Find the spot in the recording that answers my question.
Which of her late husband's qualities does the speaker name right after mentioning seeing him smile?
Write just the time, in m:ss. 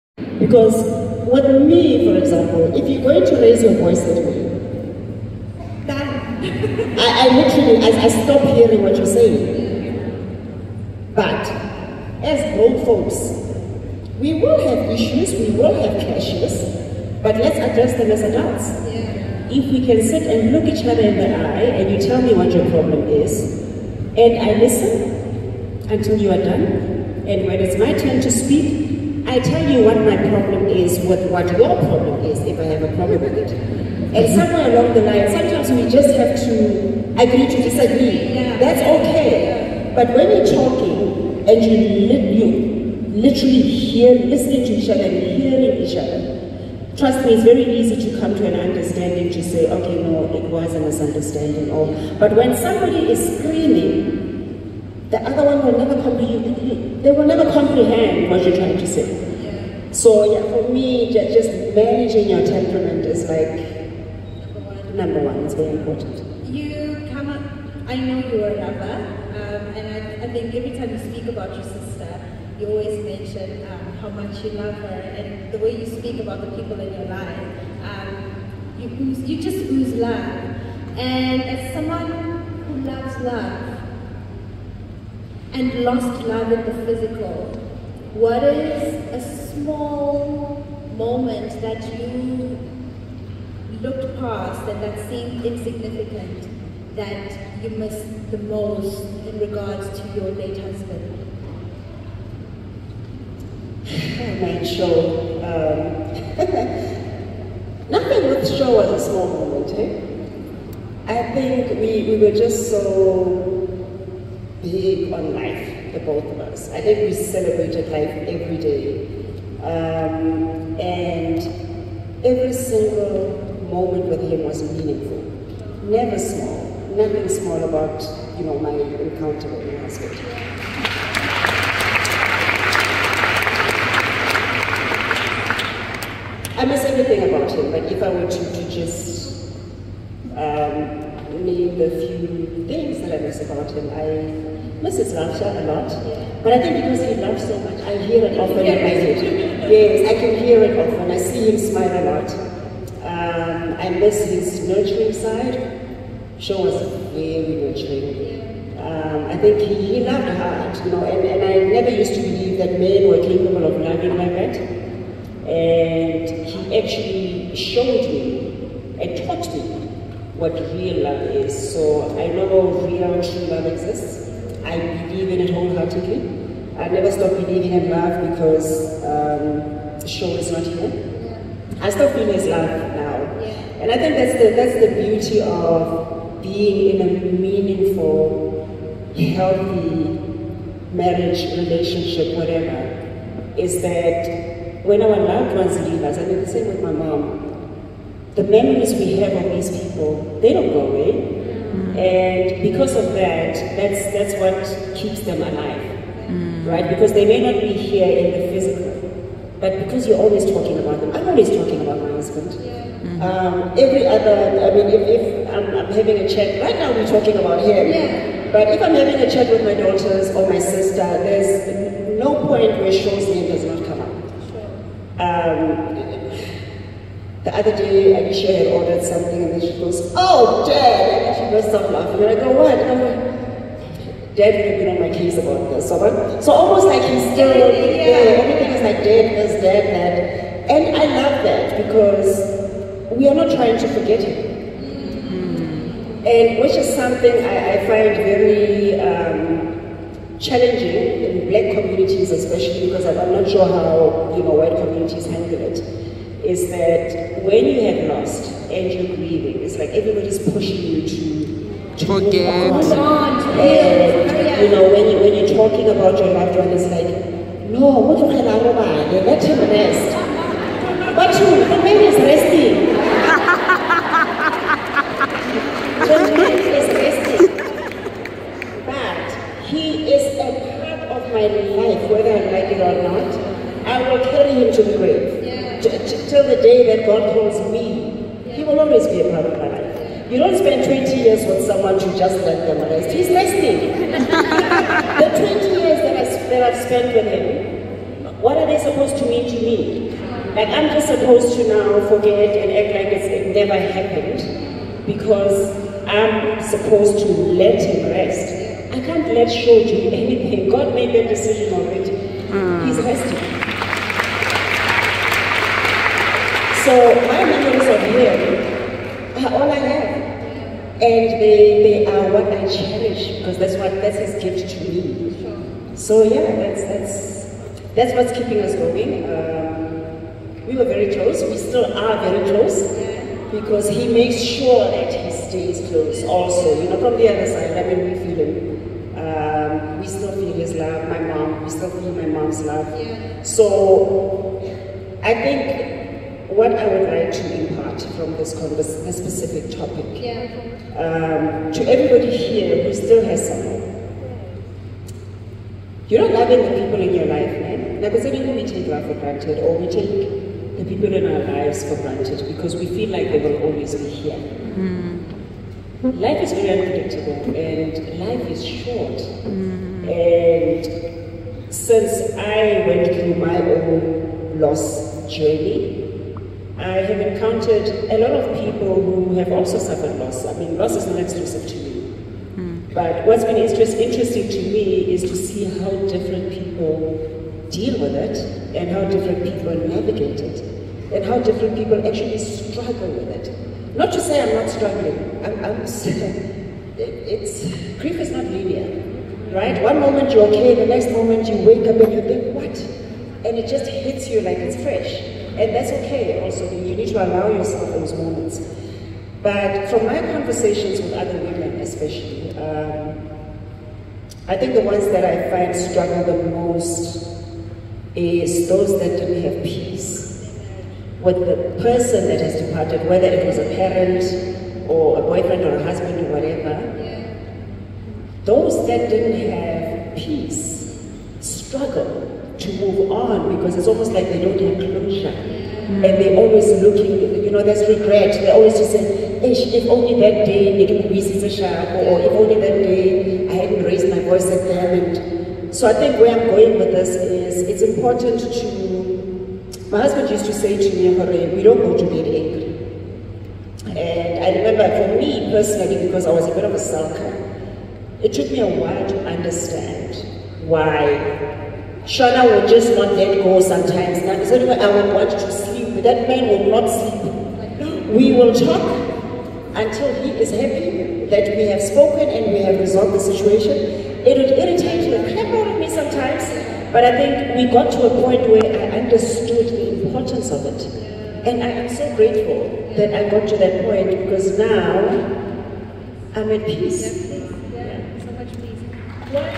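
2:34.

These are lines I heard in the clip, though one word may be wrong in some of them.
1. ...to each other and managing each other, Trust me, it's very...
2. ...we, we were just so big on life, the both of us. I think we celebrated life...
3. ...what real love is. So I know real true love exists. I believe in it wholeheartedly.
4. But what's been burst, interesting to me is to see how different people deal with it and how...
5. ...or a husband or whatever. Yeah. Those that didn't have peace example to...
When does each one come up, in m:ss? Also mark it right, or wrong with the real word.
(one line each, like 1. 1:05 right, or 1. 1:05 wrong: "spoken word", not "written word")
1. 0:44 wrong: "hearing", not "managing"
2. 1:51 right
3. 2:50 right
4. 6:22 wrong: "interest", not "burst"
5. 7:05 wrong: "struggle", not "example".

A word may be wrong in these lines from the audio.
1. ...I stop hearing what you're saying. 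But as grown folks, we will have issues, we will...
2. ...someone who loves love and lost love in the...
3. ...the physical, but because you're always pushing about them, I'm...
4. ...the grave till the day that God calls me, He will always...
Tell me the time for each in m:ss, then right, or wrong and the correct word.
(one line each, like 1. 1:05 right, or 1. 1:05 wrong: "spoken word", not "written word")
1. 0:08 right
2. 1:21 right
3. 3:28 wrong: "talking", not "pushing"
4. 4:44 right.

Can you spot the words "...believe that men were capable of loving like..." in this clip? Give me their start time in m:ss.
2:42.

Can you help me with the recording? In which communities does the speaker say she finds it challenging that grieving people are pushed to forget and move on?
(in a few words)
Black communities.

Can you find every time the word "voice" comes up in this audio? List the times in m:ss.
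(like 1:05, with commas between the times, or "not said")
0:03, 7:24.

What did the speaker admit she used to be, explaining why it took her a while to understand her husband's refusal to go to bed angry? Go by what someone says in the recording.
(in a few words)
A sulker.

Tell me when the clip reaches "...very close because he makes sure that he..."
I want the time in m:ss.
5:32.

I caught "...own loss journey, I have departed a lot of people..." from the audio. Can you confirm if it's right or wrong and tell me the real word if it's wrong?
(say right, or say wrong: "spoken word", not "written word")
wrong: "encountered", not "departed".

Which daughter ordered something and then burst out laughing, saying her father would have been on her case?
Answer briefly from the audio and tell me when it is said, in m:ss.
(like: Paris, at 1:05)
Alicia, at 3:48.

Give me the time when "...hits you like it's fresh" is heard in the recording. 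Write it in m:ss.
6:43.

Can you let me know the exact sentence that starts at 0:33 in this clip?
And somewhere along the line, sometimes we just have to agree to disagree.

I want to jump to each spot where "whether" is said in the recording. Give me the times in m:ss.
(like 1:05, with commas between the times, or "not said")
4:42, 7:03.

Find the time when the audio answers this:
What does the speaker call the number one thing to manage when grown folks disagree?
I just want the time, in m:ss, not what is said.
1:01.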